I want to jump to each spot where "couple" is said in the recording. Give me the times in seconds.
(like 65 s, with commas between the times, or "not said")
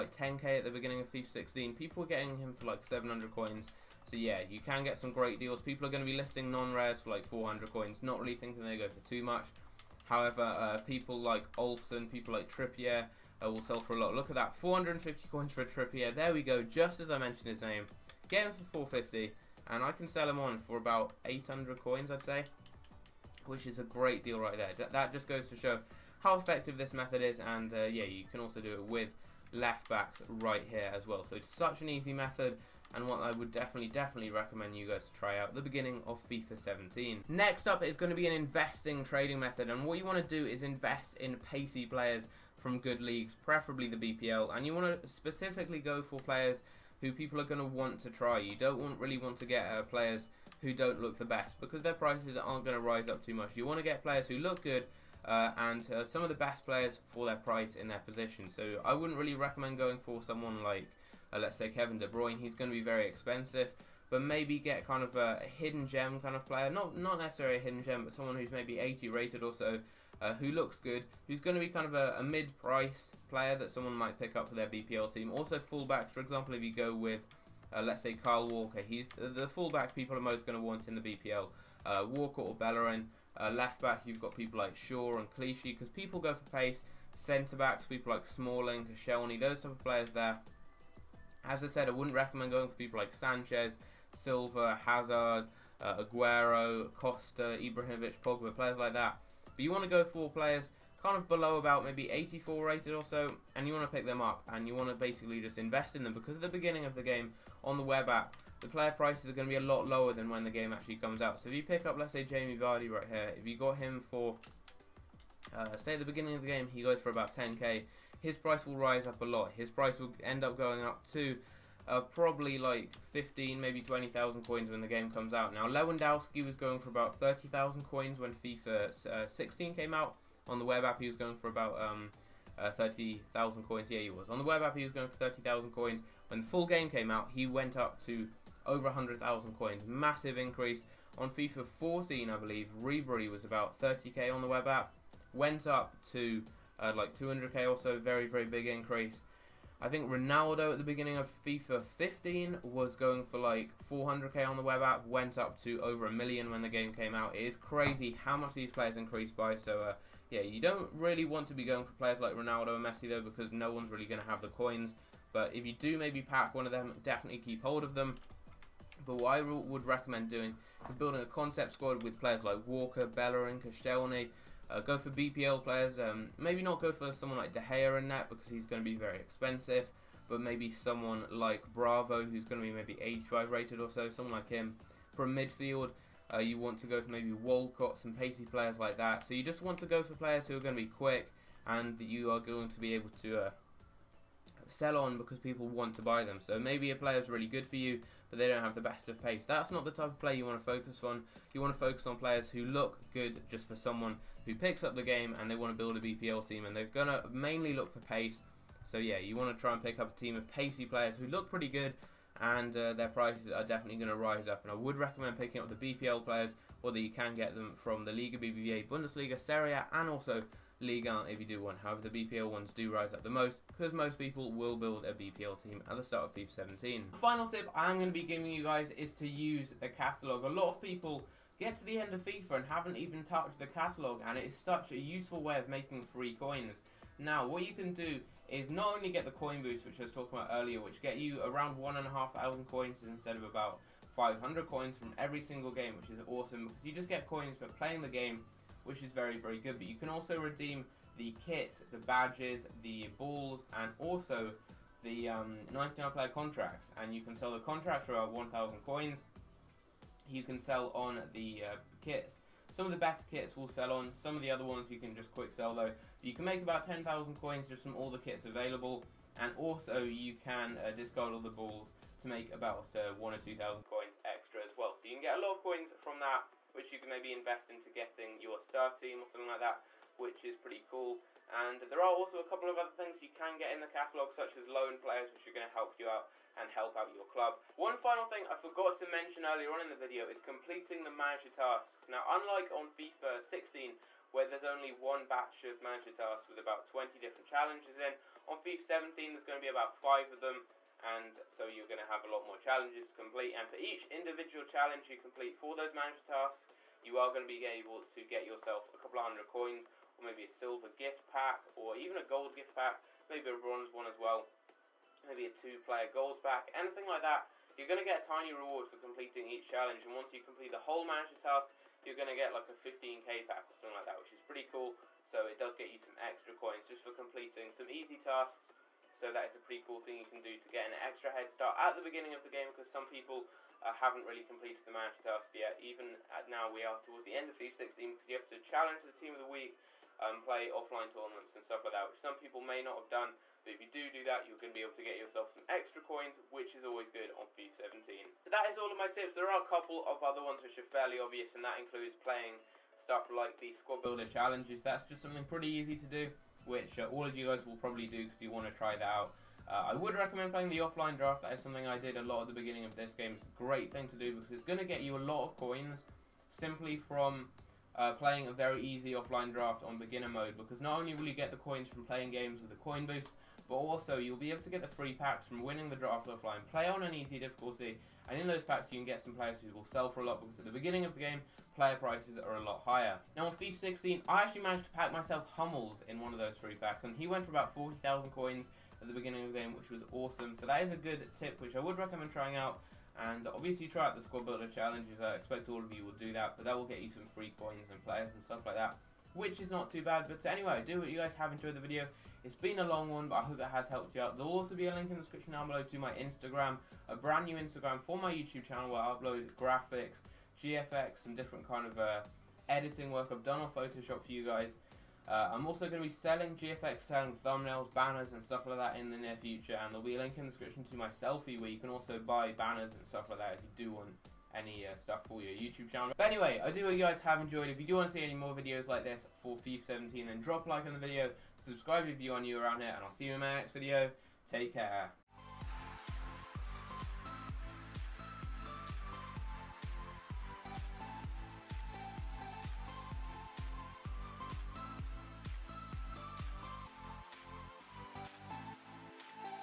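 282 s, 308 s, 349 s.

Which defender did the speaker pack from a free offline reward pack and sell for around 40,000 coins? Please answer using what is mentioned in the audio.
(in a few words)
Hummels.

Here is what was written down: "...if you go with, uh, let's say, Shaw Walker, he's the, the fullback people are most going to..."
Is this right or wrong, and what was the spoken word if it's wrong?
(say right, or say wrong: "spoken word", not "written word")
wrong: "Kyle", not "Shaw".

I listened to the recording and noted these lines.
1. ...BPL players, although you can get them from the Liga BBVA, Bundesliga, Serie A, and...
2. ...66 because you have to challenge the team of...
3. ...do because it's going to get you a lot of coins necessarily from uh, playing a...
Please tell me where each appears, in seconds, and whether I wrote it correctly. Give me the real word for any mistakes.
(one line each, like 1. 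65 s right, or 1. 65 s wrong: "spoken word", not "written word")
1. 215 s right
2. 337 s wrong: "16", not "66"
3. 364 s wrong: "simply", not "necessarily".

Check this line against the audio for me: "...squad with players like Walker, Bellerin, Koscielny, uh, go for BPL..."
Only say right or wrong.
right.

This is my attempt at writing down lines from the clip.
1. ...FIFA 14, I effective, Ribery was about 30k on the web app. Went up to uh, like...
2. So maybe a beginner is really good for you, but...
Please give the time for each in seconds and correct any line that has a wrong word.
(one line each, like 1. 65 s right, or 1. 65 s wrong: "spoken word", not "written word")
1. 141 s wrong: "believe", not "effective"
2. 196 s wrong: "player", not "beginner".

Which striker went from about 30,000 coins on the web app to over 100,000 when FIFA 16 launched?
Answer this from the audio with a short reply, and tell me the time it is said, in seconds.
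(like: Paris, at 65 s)
Lewandowski, at 125 s.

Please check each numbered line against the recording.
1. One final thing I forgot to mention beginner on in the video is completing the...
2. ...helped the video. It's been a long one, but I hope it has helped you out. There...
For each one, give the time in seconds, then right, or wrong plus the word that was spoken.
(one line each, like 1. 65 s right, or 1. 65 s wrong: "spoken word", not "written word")
1. 287 s wrong: "earlier", not "beginner"
2. 401 s wrong: "enjoyed", not "helped".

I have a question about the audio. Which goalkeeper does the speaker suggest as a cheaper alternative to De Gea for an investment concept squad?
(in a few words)
Bravo.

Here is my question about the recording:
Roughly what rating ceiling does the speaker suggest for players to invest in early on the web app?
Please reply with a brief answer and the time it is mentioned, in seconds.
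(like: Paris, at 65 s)
84, at 102 s.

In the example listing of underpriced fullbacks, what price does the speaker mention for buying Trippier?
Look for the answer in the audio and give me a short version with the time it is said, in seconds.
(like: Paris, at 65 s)
450 coins, at 14 s.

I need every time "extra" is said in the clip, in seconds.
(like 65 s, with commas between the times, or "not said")
274 s, 326 s, 331 s, 345 s.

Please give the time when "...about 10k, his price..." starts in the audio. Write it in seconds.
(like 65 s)
117 s.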